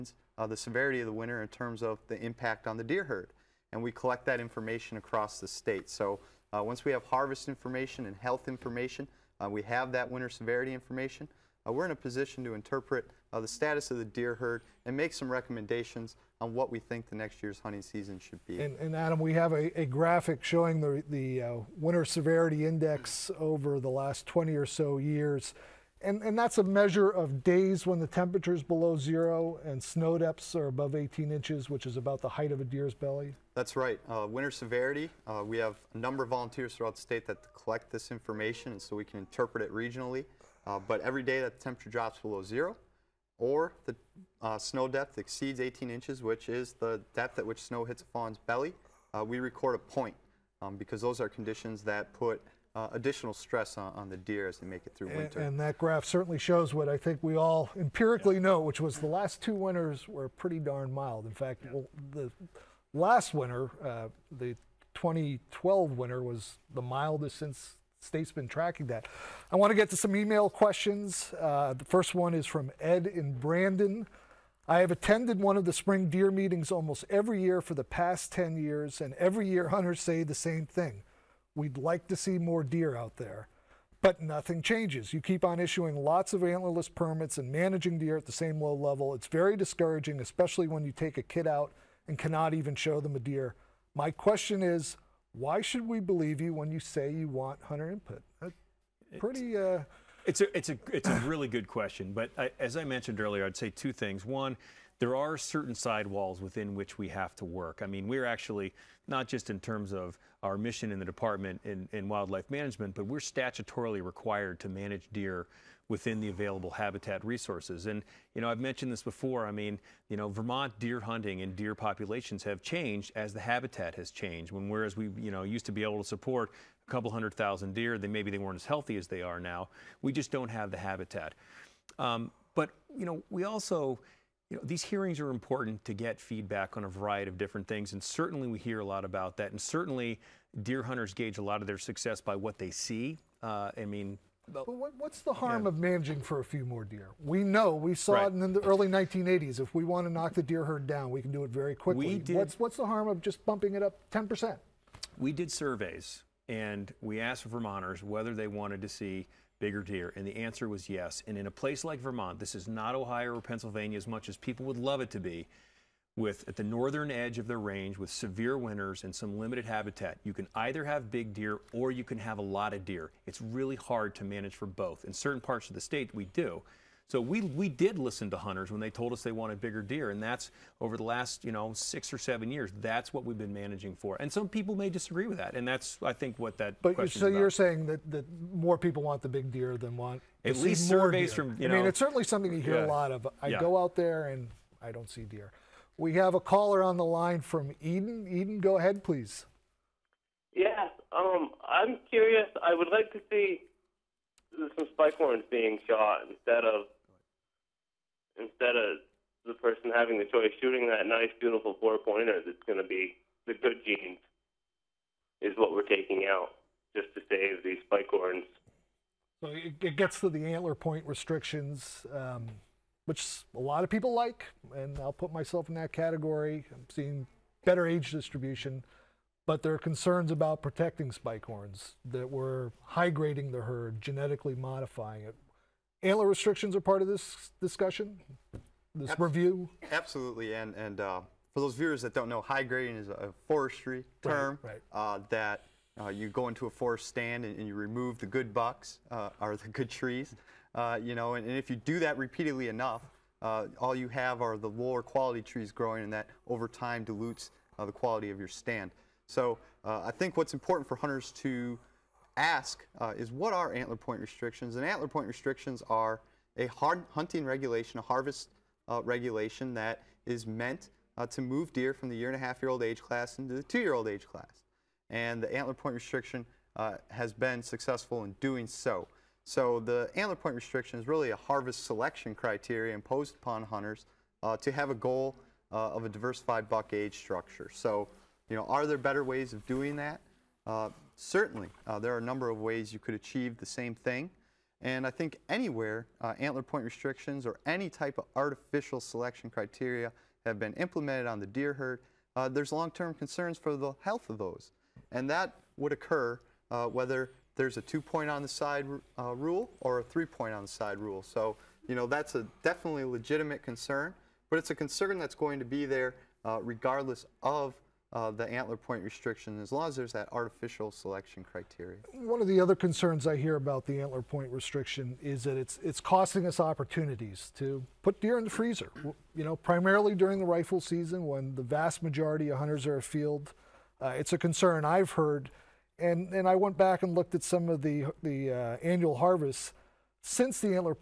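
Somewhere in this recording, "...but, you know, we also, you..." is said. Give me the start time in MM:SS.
02:12.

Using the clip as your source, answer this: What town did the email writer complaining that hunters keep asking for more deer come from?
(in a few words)
Brandon.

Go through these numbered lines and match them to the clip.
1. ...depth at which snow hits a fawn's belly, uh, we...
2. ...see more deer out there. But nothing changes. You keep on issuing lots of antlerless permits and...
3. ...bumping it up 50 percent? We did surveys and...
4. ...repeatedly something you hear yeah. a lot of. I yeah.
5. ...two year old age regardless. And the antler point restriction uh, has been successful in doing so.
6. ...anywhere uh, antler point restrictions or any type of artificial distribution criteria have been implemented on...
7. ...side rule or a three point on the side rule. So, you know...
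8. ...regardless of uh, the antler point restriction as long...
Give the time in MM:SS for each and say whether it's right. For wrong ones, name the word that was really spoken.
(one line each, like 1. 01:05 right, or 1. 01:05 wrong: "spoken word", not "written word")
1. 00:47 right
2. 01:22 right
3. 02:33 wrong: "10", not "50"
4. 03:11 wrong: "certainly", not "repeatedly"
5. 04:33 wrong: "class", not "regardless"
6. 04:55 wrong: "selection", not "distribution"
7. 05:08 right
8. 05:16 right.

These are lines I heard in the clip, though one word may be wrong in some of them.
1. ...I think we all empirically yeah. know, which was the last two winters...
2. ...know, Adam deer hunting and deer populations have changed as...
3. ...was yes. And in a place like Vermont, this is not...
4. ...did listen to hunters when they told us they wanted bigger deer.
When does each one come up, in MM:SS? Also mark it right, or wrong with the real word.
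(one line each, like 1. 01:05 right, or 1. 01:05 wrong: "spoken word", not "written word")
1. 00:56 right
2. 02:00 wrong: "Vermont", not "Adam"
3. 02:40 right
4. 02:57 right.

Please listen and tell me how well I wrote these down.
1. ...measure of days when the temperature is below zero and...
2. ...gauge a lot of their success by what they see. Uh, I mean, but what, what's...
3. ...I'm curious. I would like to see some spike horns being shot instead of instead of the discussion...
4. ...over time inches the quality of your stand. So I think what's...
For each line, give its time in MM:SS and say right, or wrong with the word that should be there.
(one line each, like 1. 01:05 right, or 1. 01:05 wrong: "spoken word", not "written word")
1. 00:26 right
2. 02:21 right
3. 03:21 wrong: "person", not "discussion"
4. 04:16 wrong: "dilutes", not "inches".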